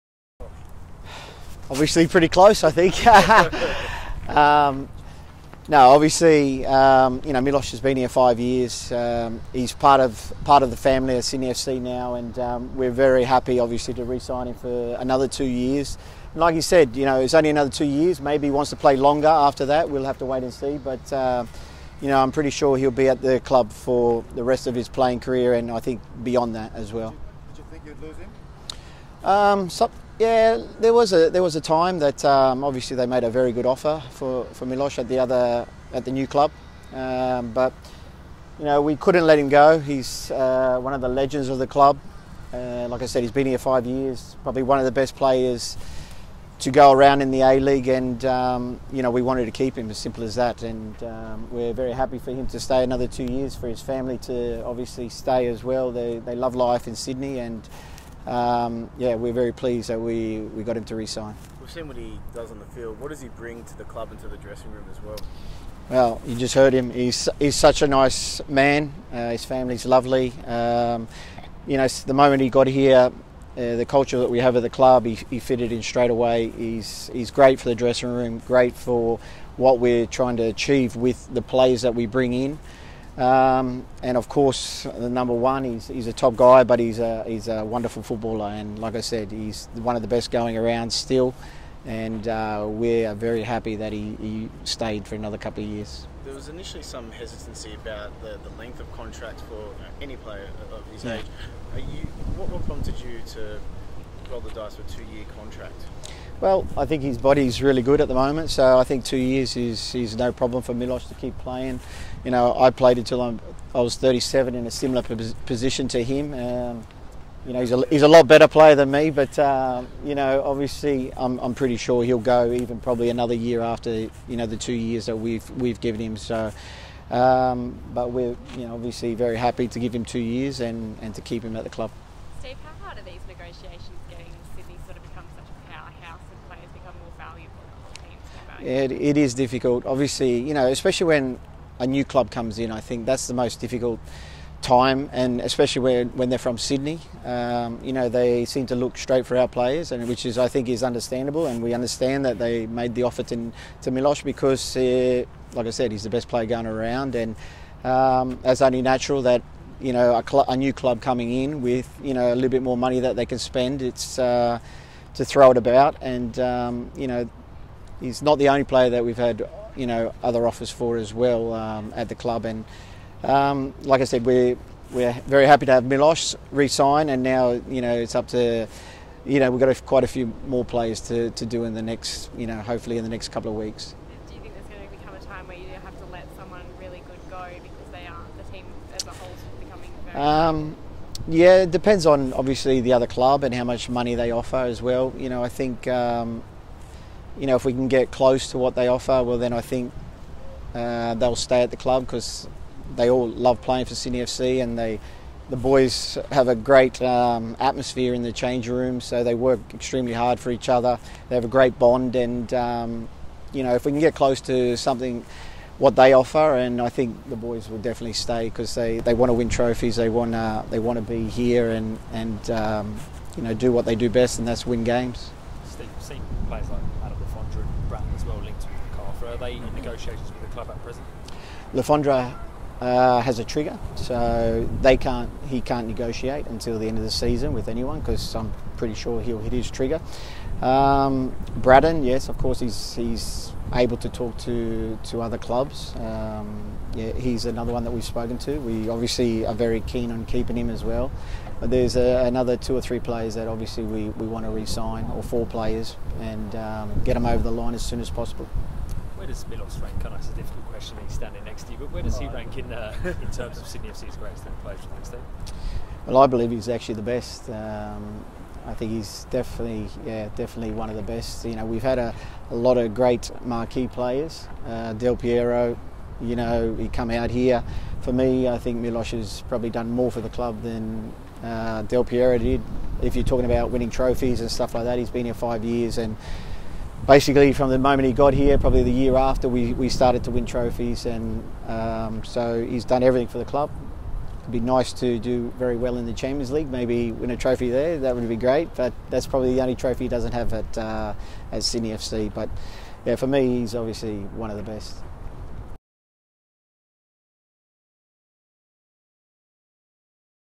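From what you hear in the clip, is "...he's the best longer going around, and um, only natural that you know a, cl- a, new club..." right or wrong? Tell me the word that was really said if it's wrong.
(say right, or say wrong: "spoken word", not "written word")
wrong: "player", not "longer".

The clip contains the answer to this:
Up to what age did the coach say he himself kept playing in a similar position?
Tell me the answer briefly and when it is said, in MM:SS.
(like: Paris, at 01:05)
37, at 01:53.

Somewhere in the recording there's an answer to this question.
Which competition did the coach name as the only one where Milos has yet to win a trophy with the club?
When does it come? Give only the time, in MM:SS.
04:56.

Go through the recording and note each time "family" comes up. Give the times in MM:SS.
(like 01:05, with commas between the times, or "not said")
00:10, 00:53, 01:09.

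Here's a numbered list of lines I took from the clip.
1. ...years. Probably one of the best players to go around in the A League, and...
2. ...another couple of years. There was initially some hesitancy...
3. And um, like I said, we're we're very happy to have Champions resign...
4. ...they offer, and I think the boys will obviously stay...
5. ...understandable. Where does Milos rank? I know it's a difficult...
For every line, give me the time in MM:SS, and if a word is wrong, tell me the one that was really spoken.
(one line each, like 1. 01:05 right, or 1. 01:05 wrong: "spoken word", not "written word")
1. 00:43 right
2. 01:35 right
3. 02:52 wrong: "Milos", not "Champions"
4. 03:35 wrong: "definitely", not "obviously"
5. 04:18 wrong: "possible", not "understandable".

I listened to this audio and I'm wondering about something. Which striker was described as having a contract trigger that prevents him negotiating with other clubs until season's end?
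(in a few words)
Adam Le Fondre.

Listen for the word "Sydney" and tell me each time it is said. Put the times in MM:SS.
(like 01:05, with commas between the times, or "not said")
00:11, 00:56, 02:26, 03:23, 04:23, 05:01.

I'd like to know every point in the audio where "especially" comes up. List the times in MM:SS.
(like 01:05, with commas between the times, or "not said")
02:20, 02:25.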